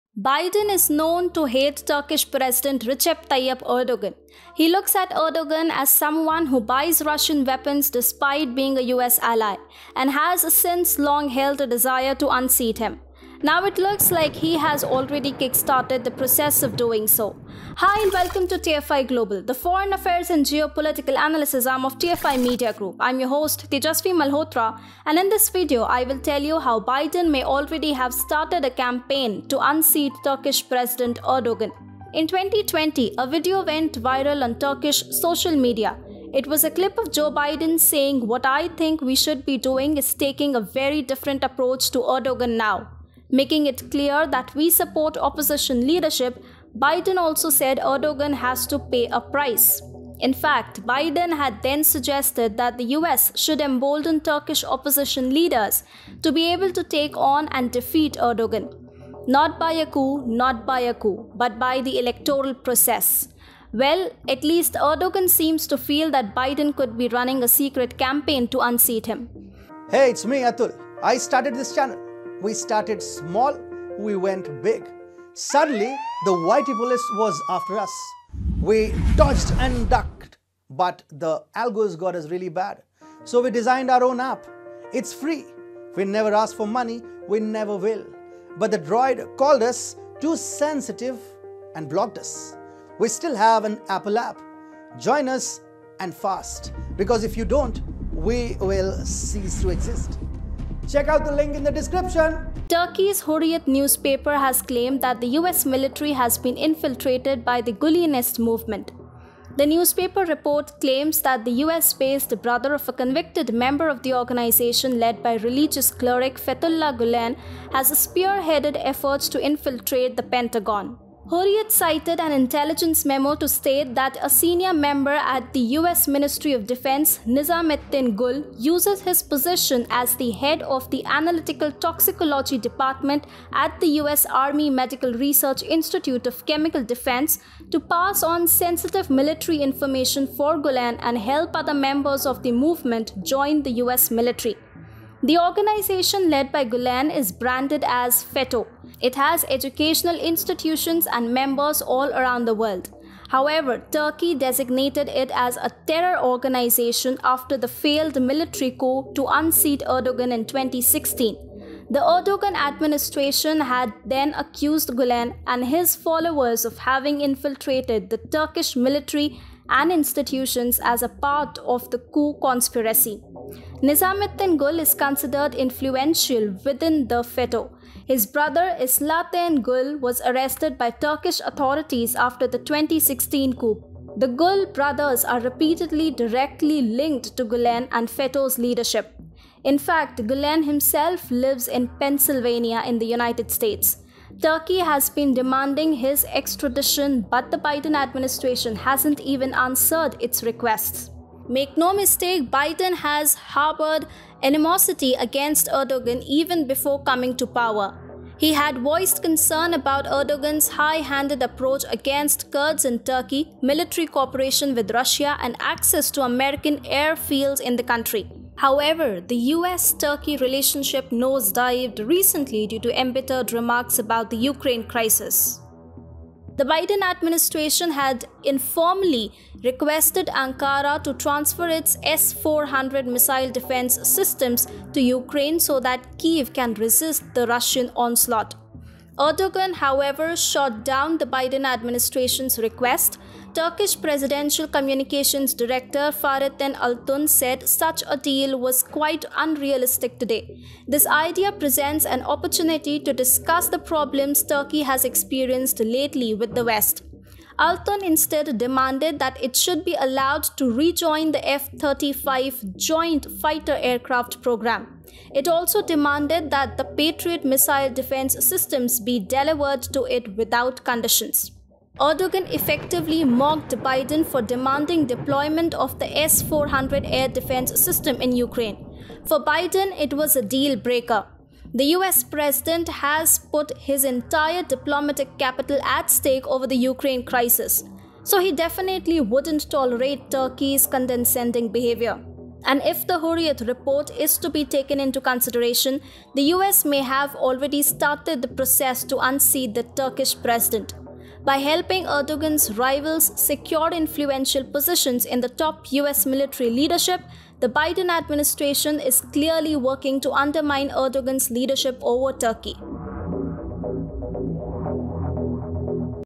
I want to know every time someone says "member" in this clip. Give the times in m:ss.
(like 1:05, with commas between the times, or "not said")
1:53, 2:04, 2:21, 2:31.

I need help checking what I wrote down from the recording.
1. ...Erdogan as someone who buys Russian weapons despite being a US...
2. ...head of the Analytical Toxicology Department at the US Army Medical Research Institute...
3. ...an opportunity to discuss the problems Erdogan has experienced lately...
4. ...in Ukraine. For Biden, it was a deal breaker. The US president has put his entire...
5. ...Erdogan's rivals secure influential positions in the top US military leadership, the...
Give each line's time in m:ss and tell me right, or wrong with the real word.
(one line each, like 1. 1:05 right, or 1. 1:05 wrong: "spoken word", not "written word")
1. 0:05 right
2. 2:10 right
3. 4:12 wrong: "Turkey", not "Erdogan"
4. 4:38 right
5. 5:02 right.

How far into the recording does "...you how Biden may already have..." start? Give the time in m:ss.
0:26.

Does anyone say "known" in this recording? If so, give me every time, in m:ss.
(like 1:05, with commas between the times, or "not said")
0:00.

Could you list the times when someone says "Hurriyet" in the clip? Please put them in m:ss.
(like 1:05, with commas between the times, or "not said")
1:43, 2:01, 4:53.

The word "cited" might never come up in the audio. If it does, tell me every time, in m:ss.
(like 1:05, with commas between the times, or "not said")
2:01.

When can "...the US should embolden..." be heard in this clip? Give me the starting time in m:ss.
0:52.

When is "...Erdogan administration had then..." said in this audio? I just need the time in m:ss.
2:41.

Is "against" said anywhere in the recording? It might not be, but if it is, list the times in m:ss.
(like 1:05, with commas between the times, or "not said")
3:25, 3:31.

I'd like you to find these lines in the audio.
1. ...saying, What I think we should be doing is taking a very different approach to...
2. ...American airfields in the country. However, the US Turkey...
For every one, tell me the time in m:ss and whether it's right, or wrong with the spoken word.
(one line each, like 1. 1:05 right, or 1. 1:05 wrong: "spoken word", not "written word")
1. 0:37 right
2. 3:36 right.